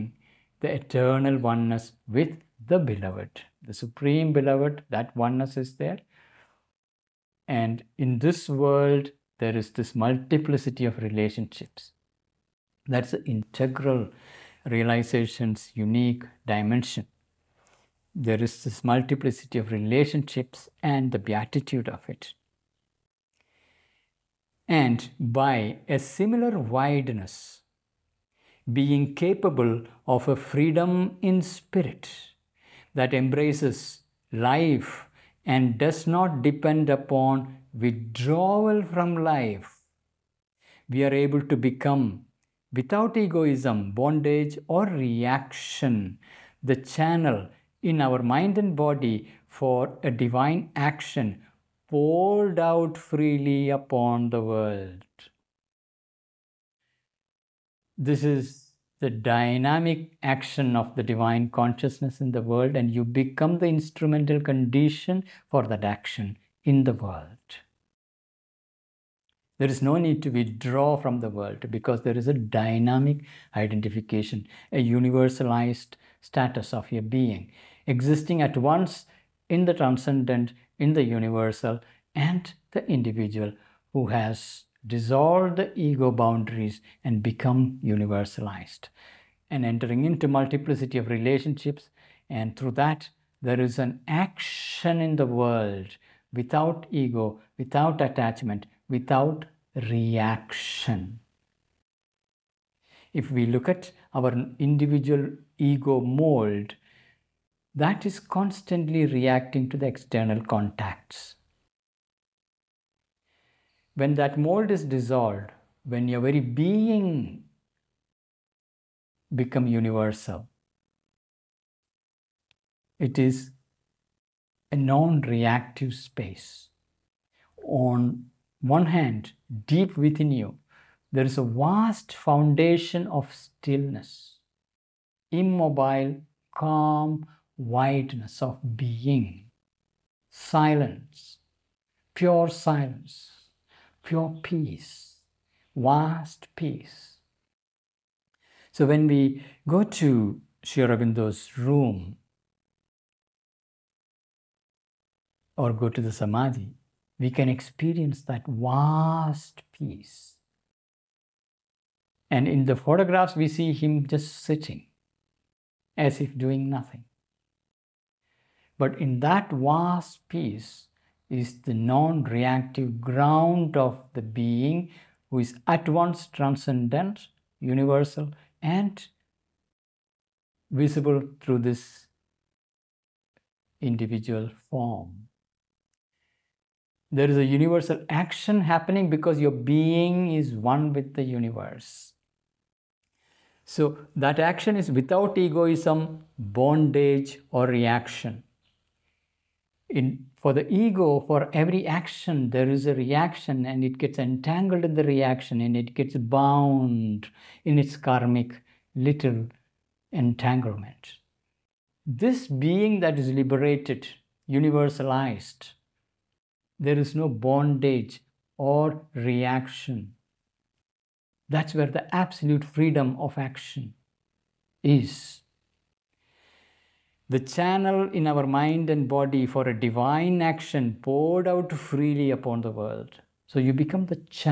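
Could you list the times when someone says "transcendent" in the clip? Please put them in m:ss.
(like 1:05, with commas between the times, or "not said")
1:19, 2:56.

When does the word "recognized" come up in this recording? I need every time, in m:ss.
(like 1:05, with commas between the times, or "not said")
not said.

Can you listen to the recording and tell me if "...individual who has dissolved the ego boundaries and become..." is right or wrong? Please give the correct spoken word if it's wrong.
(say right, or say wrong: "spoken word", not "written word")
right.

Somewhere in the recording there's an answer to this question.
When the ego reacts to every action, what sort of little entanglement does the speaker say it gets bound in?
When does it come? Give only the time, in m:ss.
3:27.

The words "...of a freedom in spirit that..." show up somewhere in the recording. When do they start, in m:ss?
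0:30.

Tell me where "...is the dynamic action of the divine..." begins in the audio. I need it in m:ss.
0:58.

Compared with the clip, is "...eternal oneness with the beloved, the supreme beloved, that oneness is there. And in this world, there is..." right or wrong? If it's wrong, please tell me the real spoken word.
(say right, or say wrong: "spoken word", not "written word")
right.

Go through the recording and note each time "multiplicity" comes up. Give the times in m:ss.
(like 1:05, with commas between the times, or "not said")
0:09, 0:18, 1:30.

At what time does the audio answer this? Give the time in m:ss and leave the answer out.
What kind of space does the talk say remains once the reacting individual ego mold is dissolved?
2:04.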